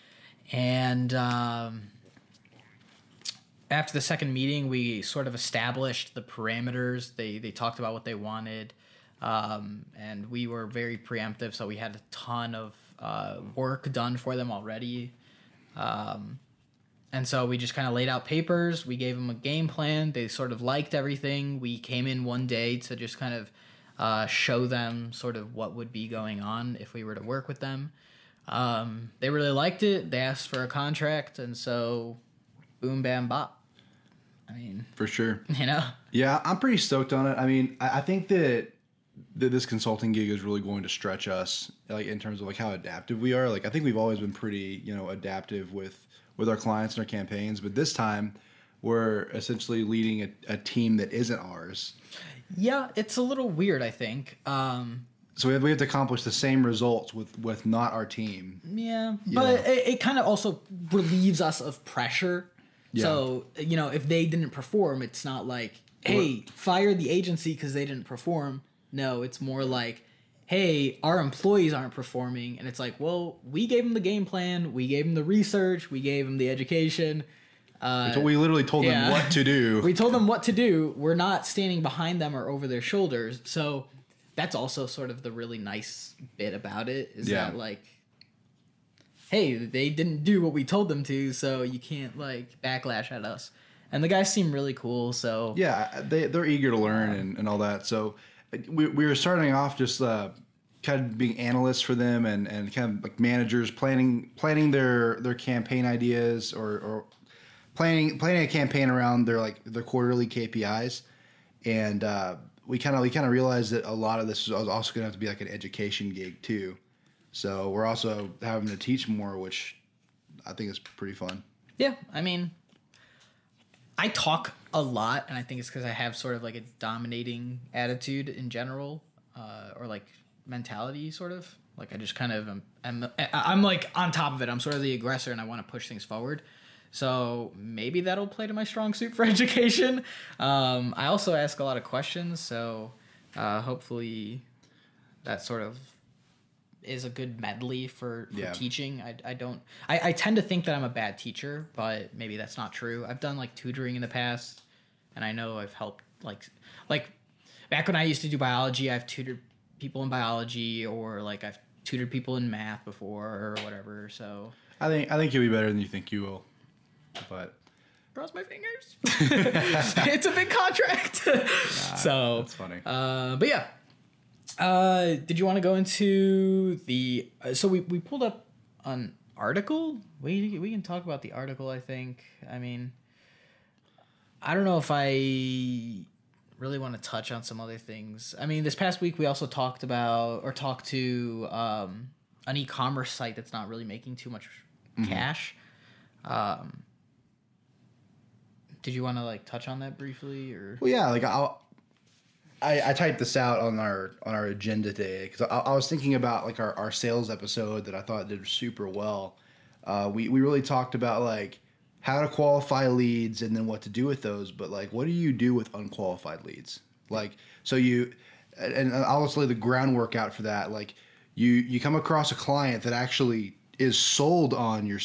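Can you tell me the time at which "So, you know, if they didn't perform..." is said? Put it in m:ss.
1:03.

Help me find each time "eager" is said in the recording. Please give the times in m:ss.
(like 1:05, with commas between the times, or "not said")
1:36.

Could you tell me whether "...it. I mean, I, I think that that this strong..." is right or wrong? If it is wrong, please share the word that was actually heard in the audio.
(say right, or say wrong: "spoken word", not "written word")
wrong: "consulting", not "strong".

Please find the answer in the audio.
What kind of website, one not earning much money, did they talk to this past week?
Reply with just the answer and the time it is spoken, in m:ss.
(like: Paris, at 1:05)
E-commerce site, at 3:12.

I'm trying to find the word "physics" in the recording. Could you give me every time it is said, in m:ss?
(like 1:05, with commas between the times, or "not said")
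not said.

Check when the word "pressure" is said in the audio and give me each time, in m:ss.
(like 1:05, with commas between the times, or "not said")
1:01.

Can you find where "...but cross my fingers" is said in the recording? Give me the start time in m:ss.
2:47.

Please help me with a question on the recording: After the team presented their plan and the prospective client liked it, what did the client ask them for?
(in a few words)
A contract.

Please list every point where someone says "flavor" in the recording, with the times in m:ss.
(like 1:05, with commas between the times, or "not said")
not said.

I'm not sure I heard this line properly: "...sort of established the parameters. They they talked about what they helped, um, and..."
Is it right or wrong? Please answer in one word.
wrong.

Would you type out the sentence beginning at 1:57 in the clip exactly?
So we're also having to teach more, which I think is pretty fun.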